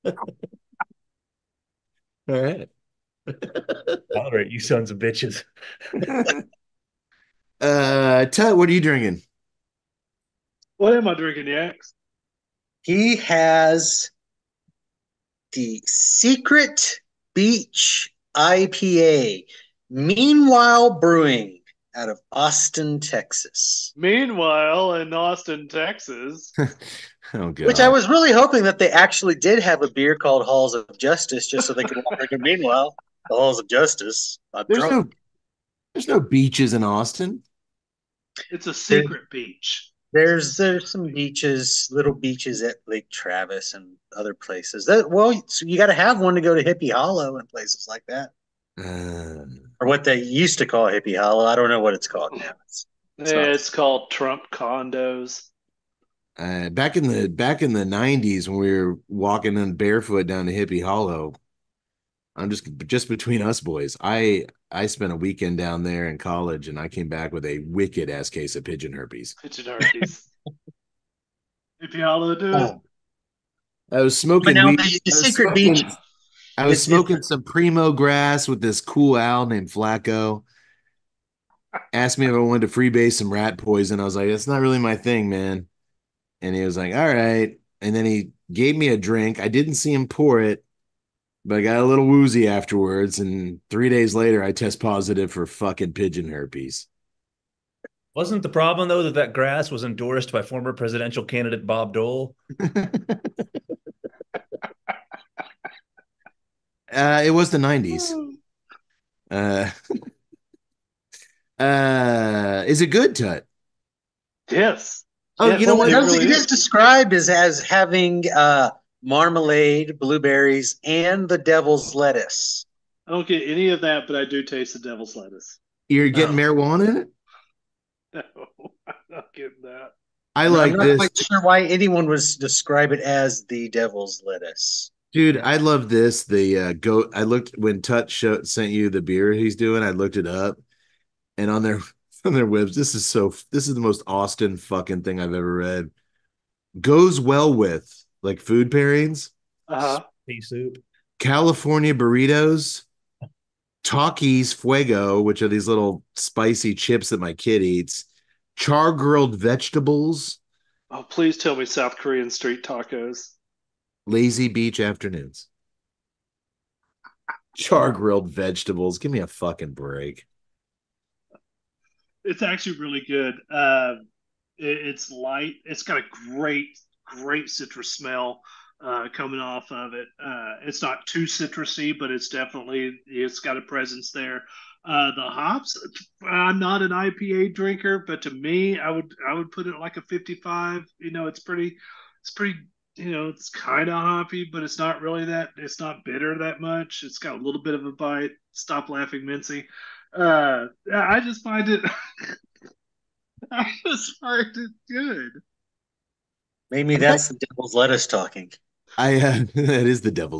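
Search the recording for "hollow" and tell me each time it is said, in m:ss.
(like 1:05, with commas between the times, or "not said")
0:46, 0:51, 1:00, 1:12.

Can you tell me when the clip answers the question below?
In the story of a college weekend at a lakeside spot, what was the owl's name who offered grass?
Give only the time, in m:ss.
1:19.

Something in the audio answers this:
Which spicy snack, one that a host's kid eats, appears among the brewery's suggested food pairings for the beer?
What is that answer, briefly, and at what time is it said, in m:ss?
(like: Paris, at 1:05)
Takis fuego, at 2:33.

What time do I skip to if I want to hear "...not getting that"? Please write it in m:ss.
2:09.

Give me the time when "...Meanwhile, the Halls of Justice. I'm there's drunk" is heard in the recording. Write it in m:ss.
0:32.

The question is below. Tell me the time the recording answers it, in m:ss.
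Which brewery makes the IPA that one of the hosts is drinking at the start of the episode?
0:19.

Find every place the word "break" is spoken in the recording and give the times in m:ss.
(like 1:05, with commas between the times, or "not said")
2:49.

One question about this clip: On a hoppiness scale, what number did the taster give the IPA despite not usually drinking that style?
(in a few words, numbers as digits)
55.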